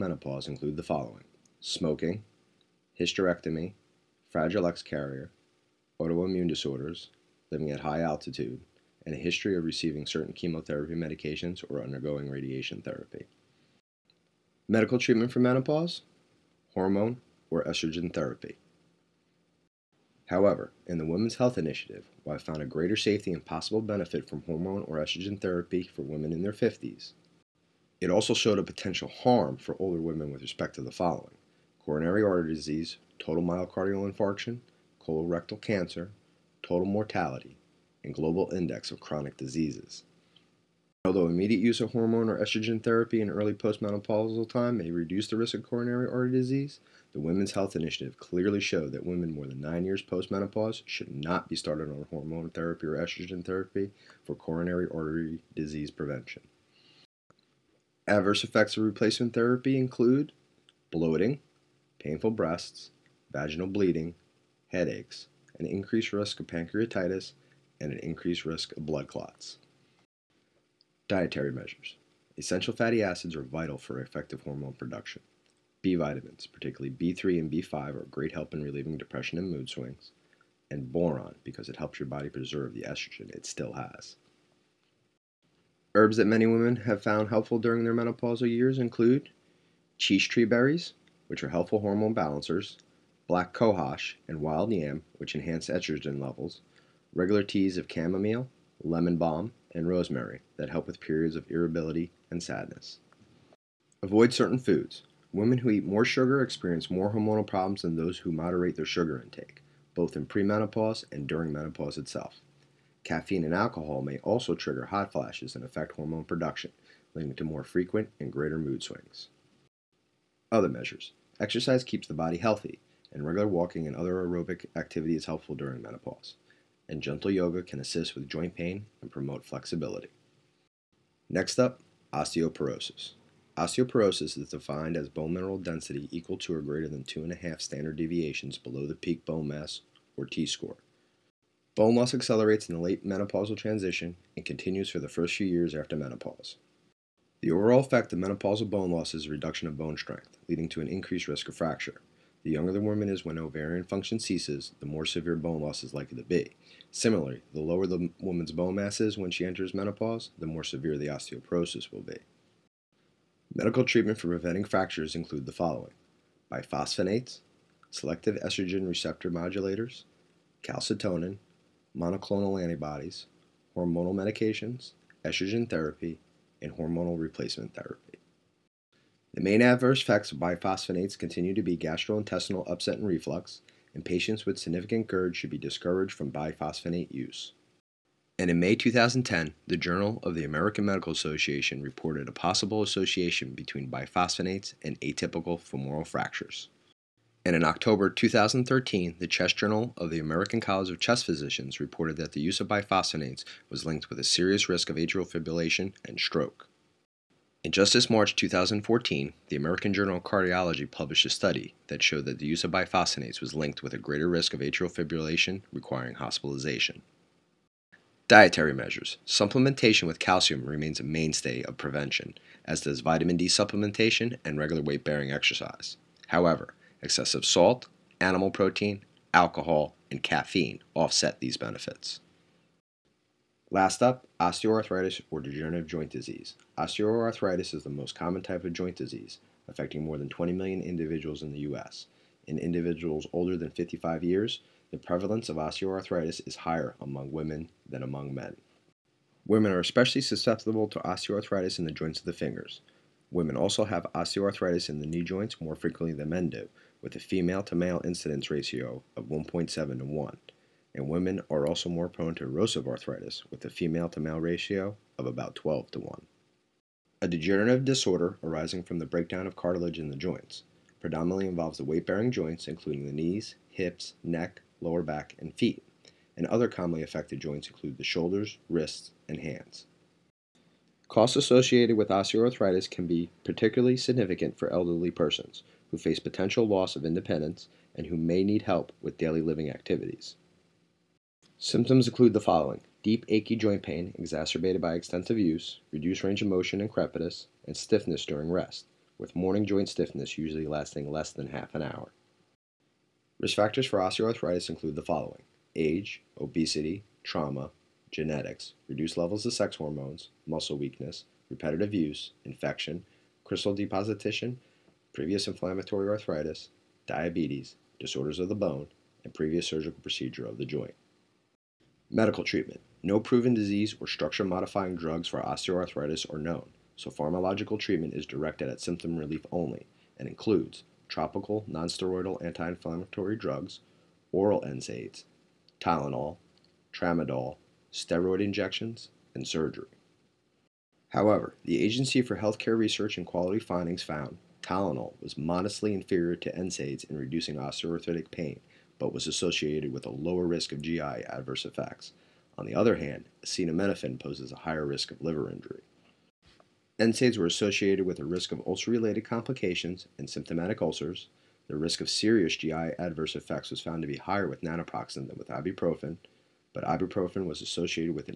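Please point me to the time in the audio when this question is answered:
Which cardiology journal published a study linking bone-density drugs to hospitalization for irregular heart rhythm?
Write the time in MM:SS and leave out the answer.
03:29.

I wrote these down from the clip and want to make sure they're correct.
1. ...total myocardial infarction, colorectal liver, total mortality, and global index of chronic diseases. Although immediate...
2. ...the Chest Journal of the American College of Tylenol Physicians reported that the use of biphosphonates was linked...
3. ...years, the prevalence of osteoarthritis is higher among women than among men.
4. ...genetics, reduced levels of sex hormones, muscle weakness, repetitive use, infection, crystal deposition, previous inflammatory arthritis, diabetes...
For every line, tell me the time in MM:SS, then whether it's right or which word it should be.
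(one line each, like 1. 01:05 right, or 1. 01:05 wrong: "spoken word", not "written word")
1. 00:33 wrong: "cancer", not "liver"
2. 03:19 wrong: "Chest", not "Tylenol"
3. 04:04 right
4. 05:08 right.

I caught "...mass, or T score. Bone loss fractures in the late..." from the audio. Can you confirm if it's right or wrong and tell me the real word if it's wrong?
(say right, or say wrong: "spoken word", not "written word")
wrong: "accelerates", not "fractures".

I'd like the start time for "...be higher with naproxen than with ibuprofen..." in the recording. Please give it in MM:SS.
06:04.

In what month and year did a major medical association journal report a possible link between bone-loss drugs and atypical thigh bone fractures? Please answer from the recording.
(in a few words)
May 2010.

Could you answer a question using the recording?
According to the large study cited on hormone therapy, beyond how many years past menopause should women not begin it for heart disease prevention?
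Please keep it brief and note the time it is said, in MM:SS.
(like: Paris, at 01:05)
9, at 00:49.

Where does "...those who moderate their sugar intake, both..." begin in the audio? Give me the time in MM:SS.
01:47.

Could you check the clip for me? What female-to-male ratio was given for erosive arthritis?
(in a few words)
12 to 1.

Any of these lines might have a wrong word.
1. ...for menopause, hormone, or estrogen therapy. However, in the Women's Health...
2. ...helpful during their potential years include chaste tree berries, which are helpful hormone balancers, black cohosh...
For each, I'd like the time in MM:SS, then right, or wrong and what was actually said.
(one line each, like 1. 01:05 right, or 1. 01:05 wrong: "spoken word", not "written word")
1. 00:15 right
2. 01:27 wrong: "menopausal", not "potential".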